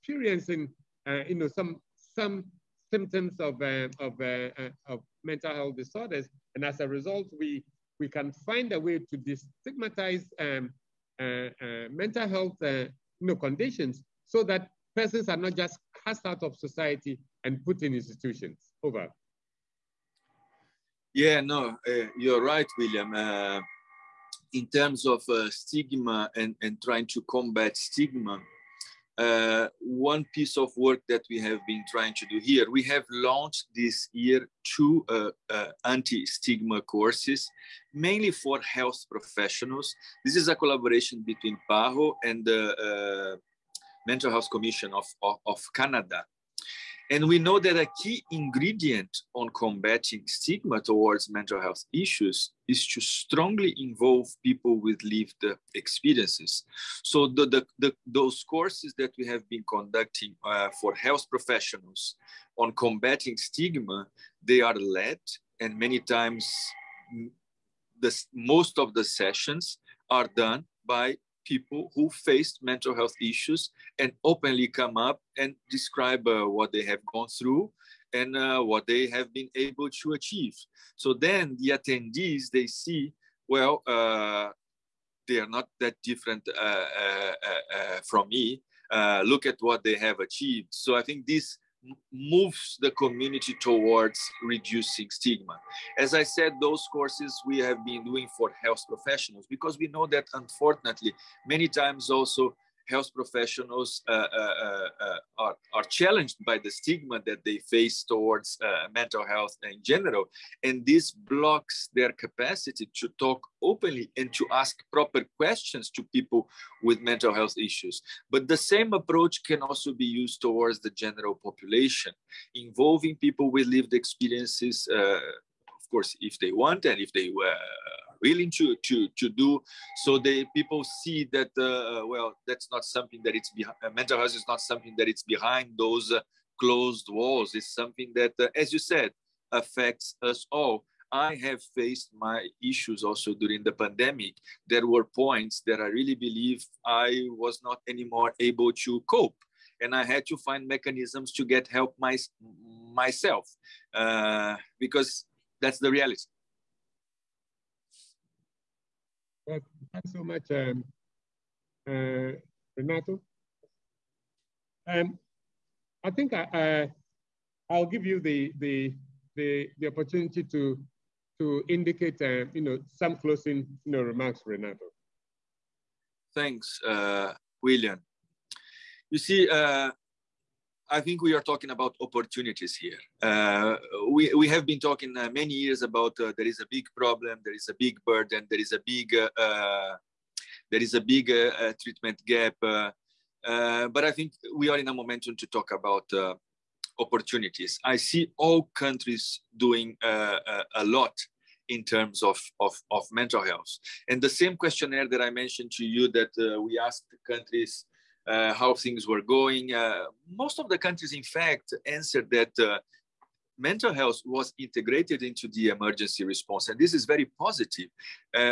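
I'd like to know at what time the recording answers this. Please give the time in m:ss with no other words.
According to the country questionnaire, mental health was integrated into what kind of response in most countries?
3:35.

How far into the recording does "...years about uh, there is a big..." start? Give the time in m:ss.
3:05.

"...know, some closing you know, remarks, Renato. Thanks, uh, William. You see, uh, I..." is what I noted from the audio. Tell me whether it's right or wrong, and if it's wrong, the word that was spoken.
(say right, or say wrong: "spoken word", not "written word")
right.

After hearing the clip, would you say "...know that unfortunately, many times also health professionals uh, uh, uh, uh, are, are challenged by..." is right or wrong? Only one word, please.
right.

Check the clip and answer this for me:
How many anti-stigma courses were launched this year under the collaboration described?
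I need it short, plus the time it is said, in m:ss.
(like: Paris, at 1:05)
2, at 0:34.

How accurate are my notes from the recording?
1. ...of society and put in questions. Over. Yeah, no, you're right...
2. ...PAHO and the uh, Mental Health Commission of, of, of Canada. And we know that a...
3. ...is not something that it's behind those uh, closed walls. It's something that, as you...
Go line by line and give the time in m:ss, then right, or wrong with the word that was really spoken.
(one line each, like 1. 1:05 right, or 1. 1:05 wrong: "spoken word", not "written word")
1. 0:16 wrong: "institutions", not "questions"
2. 0:41 right
3. 2:14 right.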